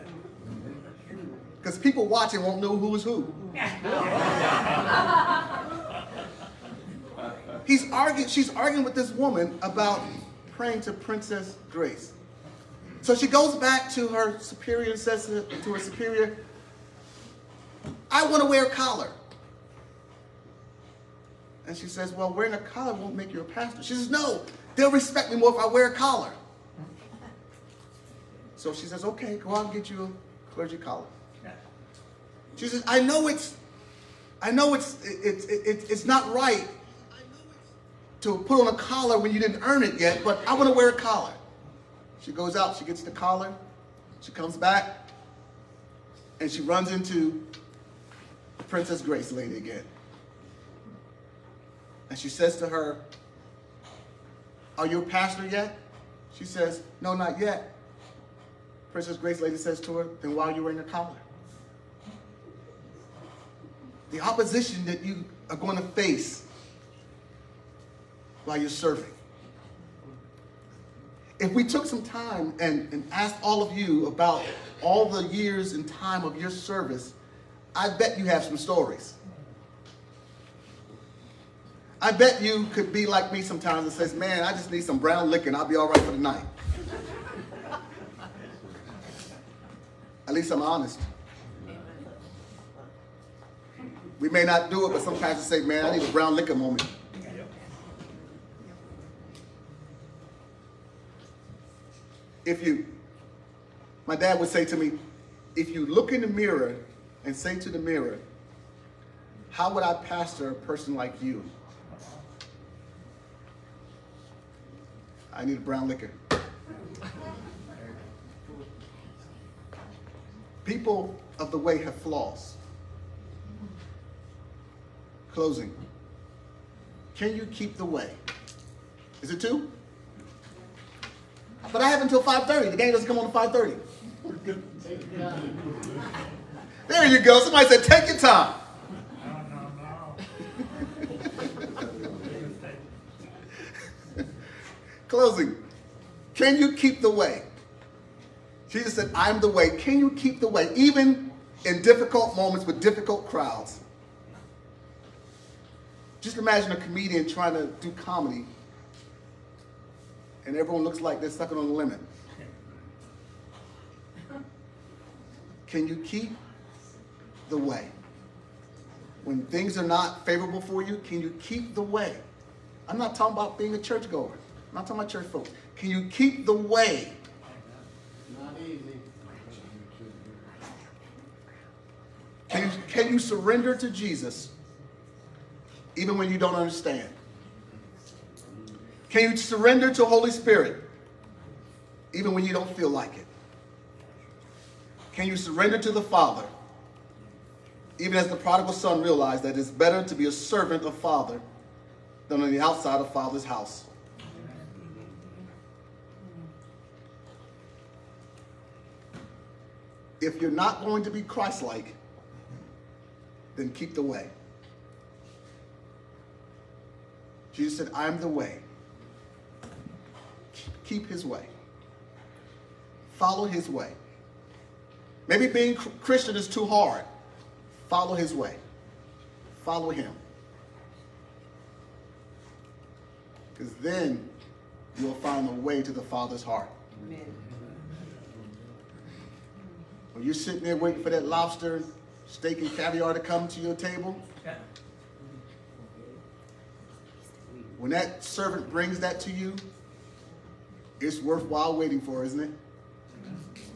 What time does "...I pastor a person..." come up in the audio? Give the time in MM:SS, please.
01:49.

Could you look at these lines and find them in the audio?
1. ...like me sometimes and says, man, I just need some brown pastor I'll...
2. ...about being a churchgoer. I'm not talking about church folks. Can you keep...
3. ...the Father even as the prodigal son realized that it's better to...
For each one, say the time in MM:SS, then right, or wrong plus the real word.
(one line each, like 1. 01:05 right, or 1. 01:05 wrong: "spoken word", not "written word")
1. 01:23 wrong: "liquor", not "pastor"
2. 02:53 right
3. 03:15 right.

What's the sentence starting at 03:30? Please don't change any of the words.
If you're not going to be Christ-like, then keep the way.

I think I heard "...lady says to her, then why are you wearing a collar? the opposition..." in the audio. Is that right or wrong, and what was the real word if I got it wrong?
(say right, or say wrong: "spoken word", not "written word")
right.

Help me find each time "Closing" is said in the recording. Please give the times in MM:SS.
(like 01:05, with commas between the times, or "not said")
02:05, 02:25.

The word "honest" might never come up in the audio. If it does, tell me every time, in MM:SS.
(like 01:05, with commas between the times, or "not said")
01:30.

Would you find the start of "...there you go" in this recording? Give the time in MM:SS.
02:16.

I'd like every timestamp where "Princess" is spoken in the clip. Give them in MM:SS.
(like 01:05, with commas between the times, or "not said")
00:10, 00:48, 00:58.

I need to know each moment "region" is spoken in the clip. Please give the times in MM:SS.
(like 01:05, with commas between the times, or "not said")
not said.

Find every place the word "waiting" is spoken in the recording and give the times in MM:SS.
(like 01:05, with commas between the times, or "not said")
04:00, 04:11.